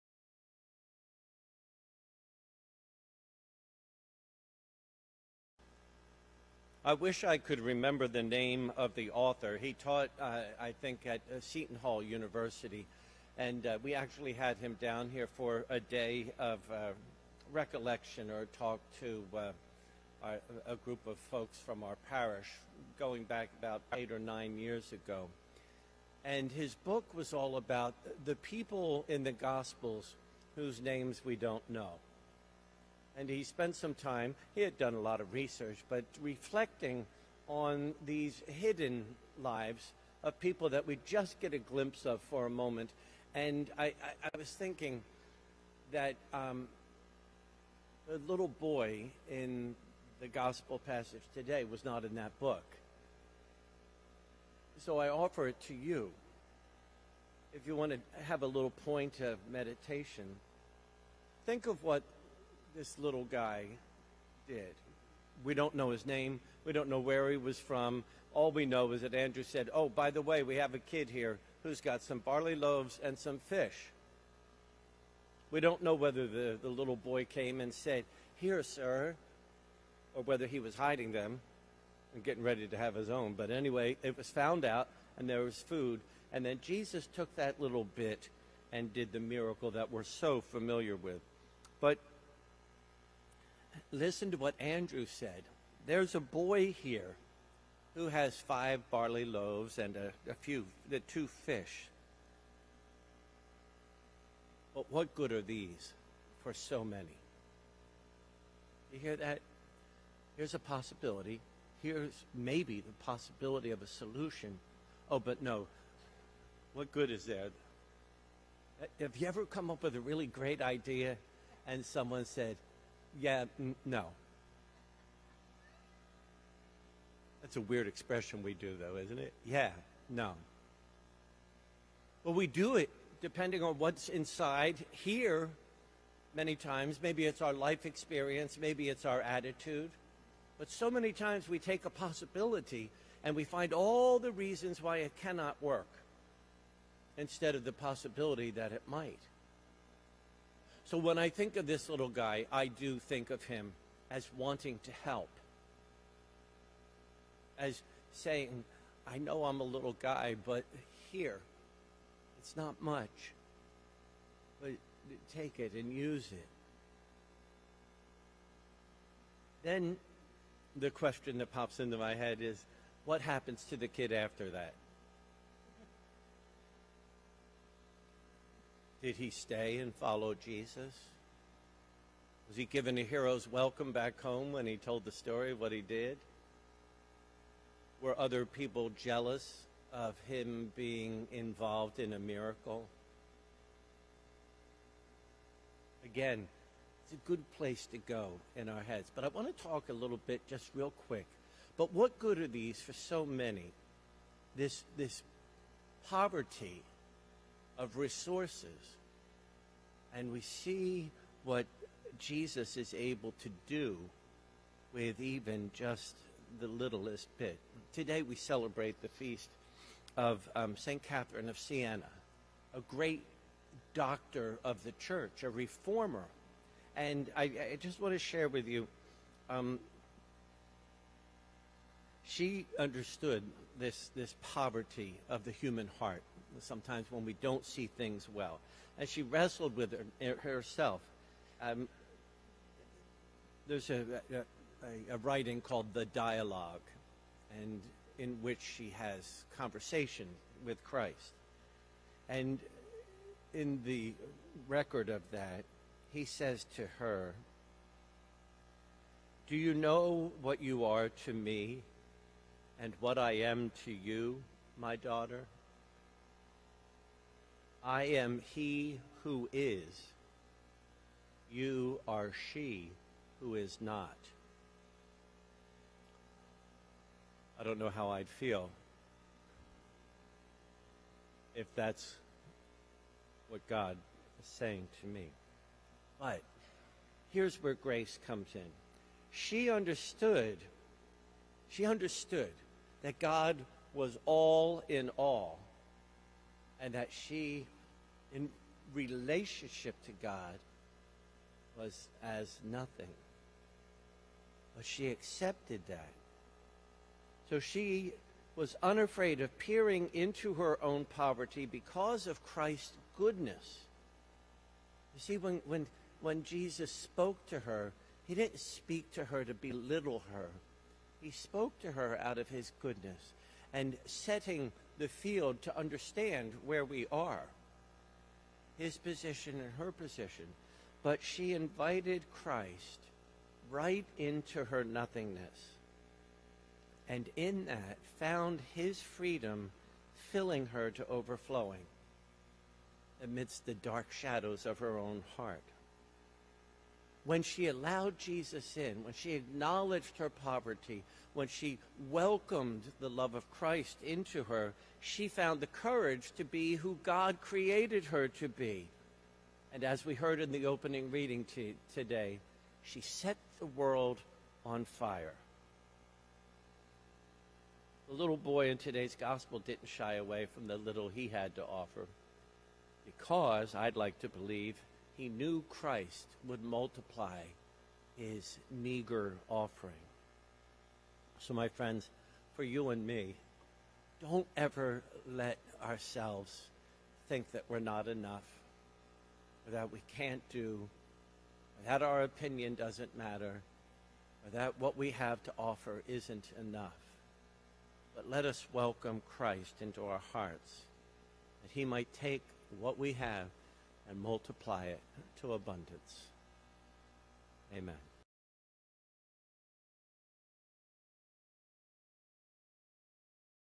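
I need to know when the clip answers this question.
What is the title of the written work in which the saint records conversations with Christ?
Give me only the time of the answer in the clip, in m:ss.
4:05.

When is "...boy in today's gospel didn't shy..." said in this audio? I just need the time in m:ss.
6:08.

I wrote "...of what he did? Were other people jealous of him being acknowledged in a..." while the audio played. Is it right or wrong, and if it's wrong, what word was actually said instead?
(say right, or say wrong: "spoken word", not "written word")
wrong: "involved", not "acknowledged".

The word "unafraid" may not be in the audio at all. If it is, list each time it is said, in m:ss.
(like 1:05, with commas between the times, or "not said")
5:08.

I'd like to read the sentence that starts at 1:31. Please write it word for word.
But listen to what Andrew said.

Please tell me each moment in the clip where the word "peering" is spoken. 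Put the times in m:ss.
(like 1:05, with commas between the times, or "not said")
5:09.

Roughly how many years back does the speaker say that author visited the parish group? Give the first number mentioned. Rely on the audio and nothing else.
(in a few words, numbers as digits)
8.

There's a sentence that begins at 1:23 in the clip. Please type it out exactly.
But anyway, it was found out, and there was food.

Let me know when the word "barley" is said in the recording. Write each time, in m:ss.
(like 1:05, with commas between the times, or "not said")
1:12, 1:38.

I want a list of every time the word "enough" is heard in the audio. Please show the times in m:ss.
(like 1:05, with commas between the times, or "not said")
6:28, 6:36.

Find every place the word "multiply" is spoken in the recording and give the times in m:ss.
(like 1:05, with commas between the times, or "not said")
6:16, 6:44.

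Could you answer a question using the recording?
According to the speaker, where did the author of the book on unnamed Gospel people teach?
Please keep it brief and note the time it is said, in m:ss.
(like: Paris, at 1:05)
Seton Hall University, at 0:11.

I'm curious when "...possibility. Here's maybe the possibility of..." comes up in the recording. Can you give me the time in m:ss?
1:50.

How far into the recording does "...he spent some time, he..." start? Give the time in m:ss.
0:33.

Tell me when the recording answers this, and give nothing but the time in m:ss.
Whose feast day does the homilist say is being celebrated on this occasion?
3:40.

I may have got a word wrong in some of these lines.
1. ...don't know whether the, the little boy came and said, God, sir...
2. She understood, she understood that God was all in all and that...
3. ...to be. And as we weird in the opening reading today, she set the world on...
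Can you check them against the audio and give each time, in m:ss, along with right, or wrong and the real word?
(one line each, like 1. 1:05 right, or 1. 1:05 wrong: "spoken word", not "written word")
1. 1:15 wrong: "Here", not "God"
2. 4:49 right
3. 5:58 wrong: "heard", not "weird".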